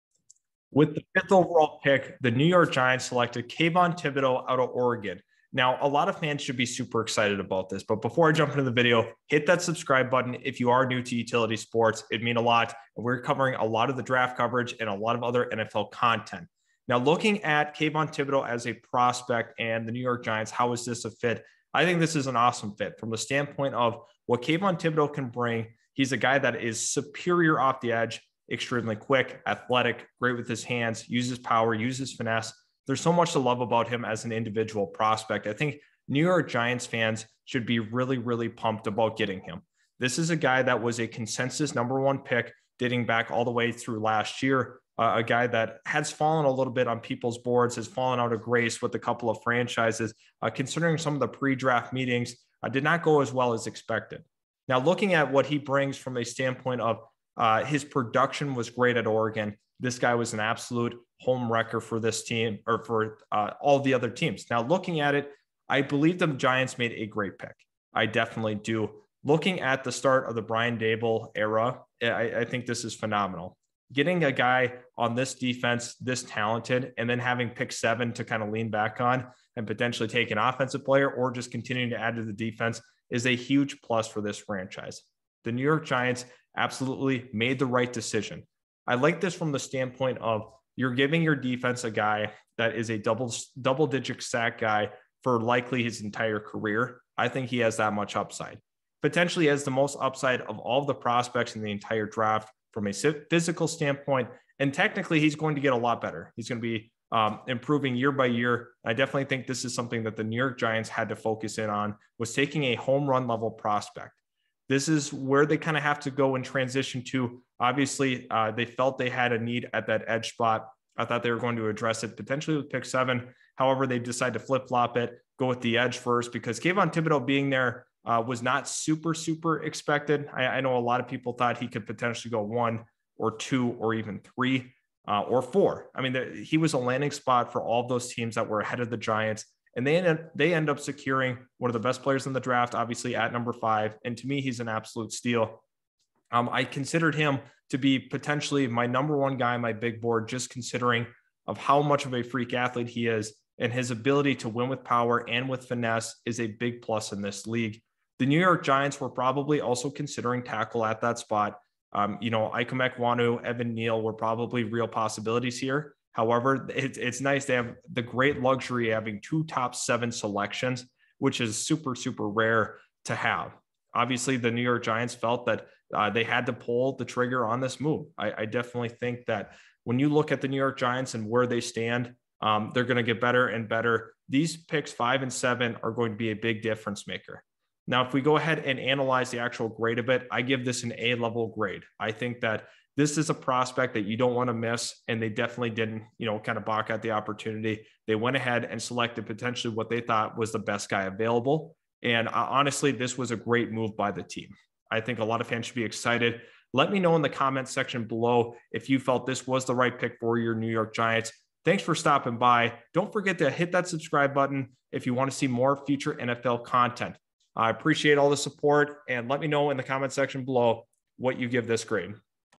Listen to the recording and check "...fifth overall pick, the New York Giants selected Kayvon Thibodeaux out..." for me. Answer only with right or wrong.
right.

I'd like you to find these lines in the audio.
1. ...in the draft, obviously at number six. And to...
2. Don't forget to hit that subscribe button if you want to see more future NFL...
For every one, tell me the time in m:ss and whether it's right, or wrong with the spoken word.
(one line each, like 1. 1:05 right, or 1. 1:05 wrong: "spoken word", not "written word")
1. 2:22 wrong: "five", not "six"
2. 3:32 right.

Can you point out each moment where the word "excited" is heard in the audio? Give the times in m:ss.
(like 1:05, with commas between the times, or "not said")
0:07, 3:25.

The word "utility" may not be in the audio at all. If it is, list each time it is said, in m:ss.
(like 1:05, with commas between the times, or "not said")
0:11.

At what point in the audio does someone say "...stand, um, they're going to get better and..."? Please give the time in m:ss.
3:01.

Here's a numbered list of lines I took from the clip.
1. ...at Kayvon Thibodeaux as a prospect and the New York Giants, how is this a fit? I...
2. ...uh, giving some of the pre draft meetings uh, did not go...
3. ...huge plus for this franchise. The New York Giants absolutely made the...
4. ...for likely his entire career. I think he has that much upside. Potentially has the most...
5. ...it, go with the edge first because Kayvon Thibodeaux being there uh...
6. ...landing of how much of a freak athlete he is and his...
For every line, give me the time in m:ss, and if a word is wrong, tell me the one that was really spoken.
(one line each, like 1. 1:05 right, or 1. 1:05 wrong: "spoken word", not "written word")
1. 0:17 right
2. 0:50 wrong: "considering", not "giving"
3. 1:23 right
4. 1:35 right
5. 2:04 right
6. 2:30 wrong: "considering", not "landing".